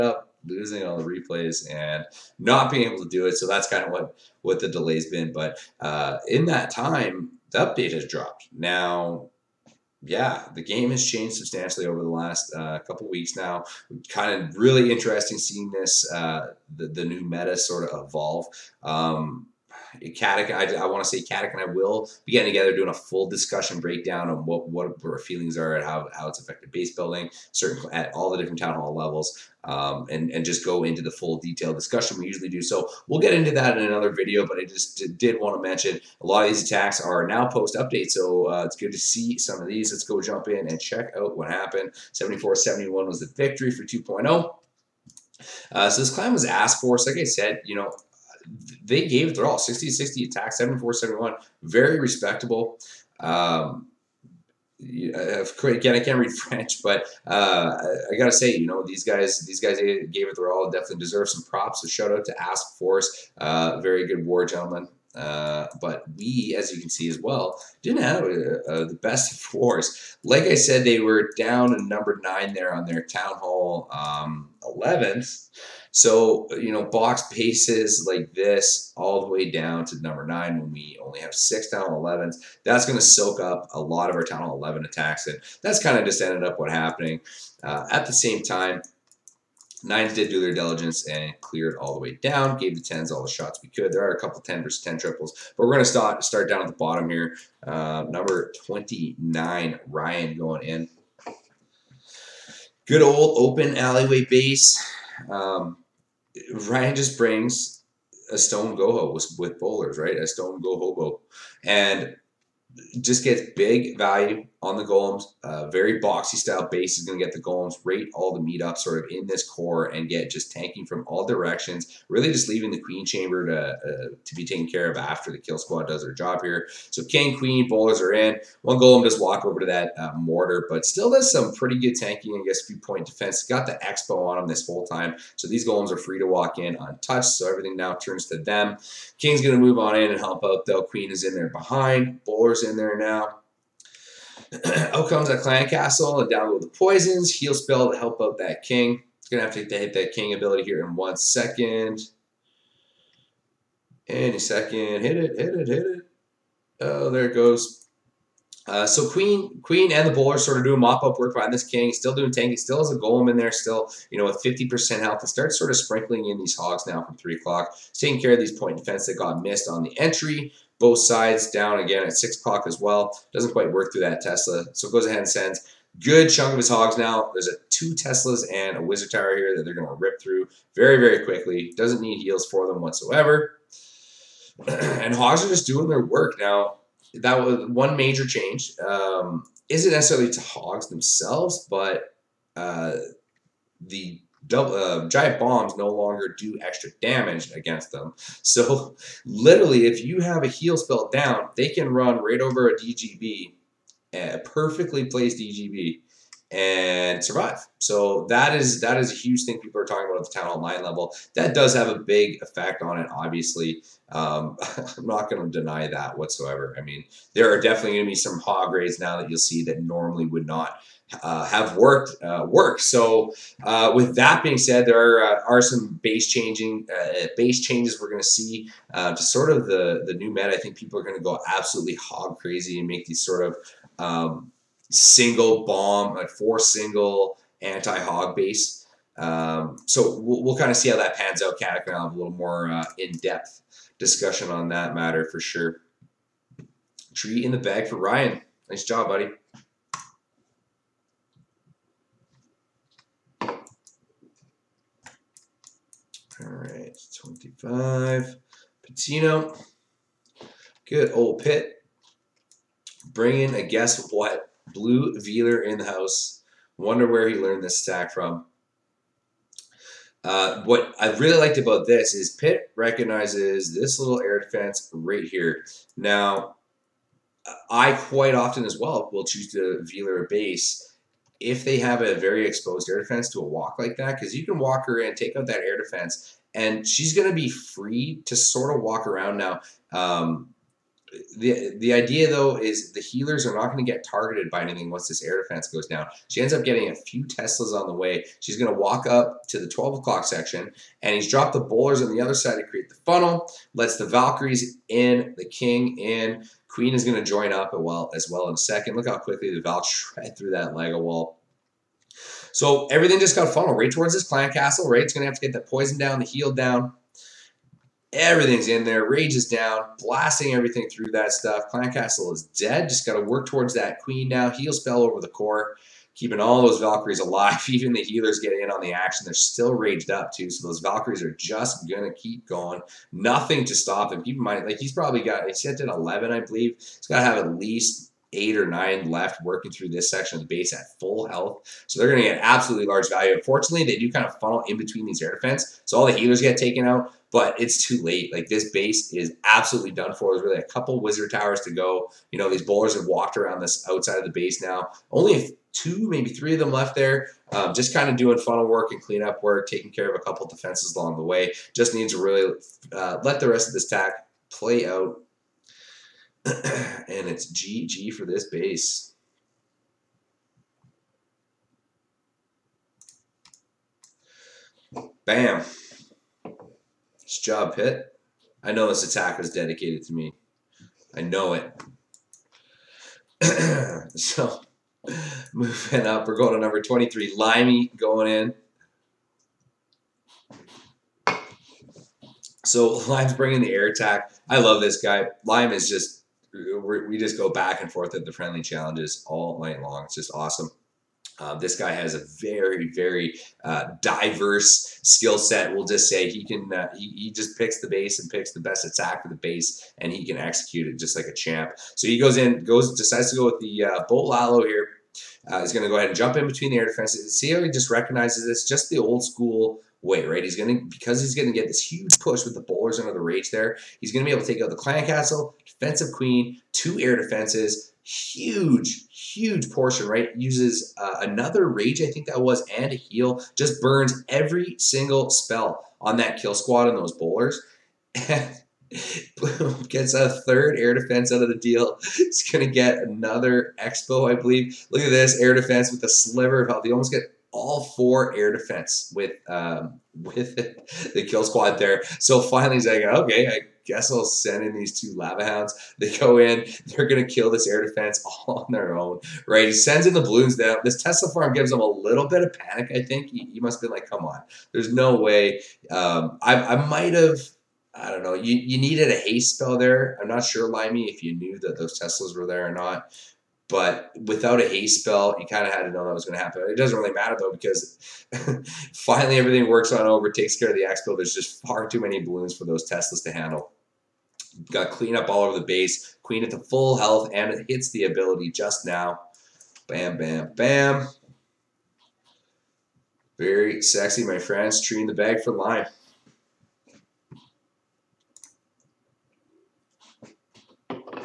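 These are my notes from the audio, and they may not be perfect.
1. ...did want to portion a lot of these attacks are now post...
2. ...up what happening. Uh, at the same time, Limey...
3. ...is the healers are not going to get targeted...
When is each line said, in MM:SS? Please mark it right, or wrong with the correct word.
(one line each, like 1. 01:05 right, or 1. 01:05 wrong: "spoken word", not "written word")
1. 00:35 wrong: "mention", not "portion"
2. 01:26 wrong: "Nines", not "Limey"
3. 04:52 right.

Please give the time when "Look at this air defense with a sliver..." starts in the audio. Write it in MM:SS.
07:24.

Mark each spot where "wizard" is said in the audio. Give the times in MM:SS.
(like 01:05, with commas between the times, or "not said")
02:58, 05:51.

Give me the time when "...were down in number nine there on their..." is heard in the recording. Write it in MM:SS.
01:10.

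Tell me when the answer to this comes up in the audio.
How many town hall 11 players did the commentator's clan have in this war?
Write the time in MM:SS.
01:21.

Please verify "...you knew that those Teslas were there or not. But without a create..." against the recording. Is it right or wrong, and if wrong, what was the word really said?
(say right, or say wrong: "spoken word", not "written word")
wrong: "haste", not "create".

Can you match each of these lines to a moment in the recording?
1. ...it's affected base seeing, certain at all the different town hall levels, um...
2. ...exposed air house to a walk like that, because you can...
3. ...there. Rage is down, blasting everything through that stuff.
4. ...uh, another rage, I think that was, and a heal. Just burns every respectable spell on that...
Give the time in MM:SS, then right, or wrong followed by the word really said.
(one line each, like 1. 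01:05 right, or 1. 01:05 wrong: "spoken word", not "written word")
1. 00:26 wrong: "building", not "seeing"
2. 04:42 wrong: "defense", not "house"
3. 05:18 right
4. 07:10 wrong: "single", not "respectable".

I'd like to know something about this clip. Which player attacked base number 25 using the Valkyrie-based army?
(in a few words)
Patino.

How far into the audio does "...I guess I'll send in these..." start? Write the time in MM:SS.
07:33.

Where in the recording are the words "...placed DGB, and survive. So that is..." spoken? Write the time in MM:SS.
03:25.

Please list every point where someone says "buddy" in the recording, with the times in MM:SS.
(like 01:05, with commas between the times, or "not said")
04:09.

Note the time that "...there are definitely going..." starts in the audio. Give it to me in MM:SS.
03:37.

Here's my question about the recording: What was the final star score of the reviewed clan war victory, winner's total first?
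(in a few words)
74-71.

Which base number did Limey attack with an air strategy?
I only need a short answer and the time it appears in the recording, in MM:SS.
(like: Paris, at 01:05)
23, at 06:26.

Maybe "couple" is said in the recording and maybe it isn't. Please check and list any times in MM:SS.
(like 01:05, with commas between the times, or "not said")
00:12, 01:34, 05:50, 06:00.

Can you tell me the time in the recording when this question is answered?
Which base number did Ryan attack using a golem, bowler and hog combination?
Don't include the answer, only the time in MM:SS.
01:38.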